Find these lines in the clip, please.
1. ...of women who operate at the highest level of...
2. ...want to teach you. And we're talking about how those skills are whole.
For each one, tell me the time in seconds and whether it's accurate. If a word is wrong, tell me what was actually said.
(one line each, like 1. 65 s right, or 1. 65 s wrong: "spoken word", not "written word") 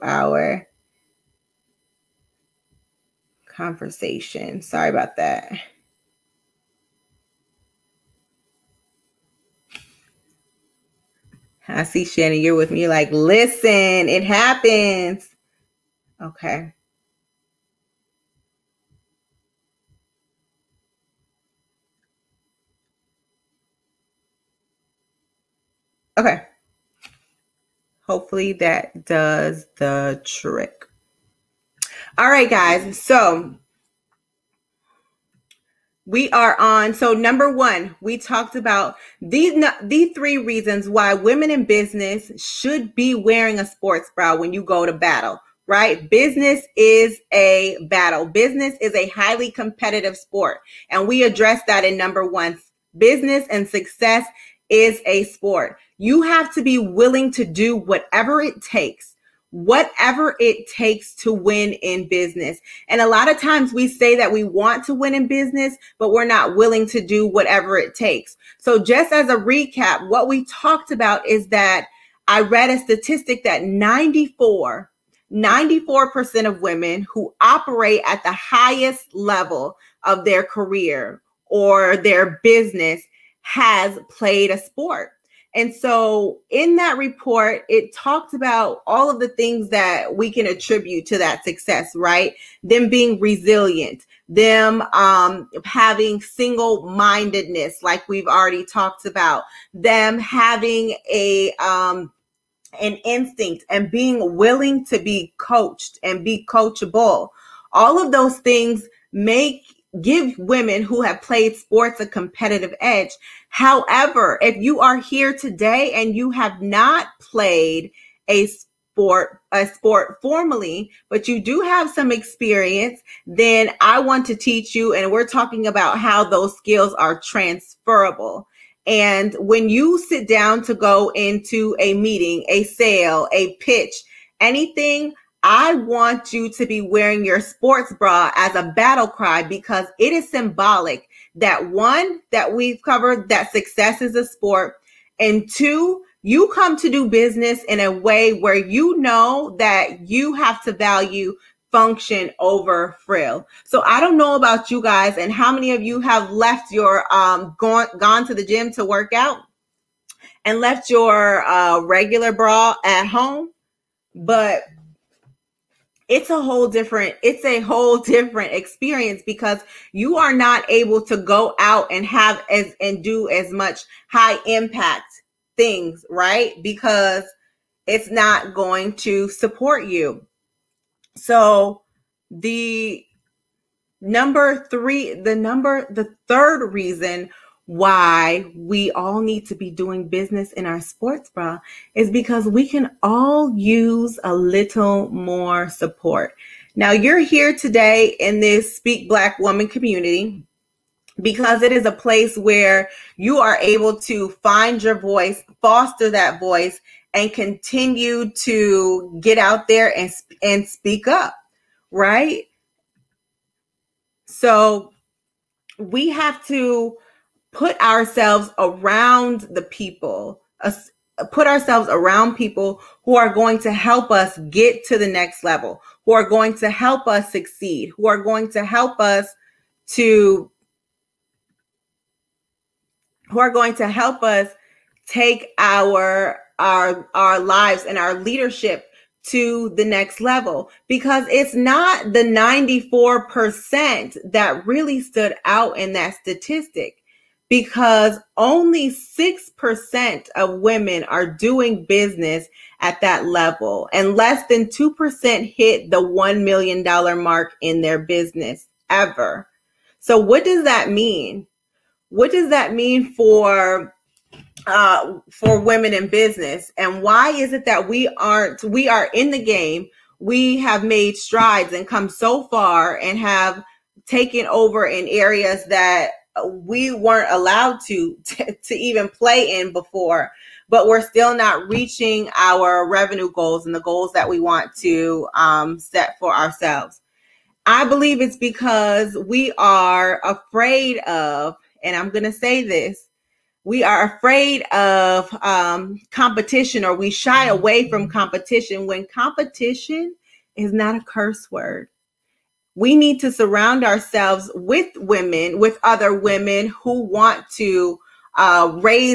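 1. 76 s right
2. 123 s wrong: "transferable", not "whole".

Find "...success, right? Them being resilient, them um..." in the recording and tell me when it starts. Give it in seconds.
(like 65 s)
91 s.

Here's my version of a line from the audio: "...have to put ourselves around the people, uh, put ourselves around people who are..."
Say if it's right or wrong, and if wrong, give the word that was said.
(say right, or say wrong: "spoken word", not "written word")
right.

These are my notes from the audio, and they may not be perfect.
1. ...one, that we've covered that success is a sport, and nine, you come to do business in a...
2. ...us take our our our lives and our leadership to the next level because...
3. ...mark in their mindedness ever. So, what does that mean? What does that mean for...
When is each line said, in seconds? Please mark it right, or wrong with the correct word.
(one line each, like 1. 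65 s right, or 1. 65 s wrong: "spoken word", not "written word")
1. 141 s wrong: "two", not "nine"
2. 234 s right
3. 257 s wrong: "business", not "mindedness".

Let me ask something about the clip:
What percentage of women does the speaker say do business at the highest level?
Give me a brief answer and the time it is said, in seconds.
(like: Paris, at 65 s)
6%, at 248 s.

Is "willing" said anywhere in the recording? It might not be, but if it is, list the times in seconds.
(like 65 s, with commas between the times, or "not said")
56 s, 66 s, 104 s.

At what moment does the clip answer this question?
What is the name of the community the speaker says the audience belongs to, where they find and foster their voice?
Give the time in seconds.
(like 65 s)
198 s.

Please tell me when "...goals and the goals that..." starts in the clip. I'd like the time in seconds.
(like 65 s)
283 s.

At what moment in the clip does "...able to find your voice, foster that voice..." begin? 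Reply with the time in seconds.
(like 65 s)
203 s.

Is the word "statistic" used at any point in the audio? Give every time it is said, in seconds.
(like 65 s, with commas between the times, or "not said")
72 s, 246 s.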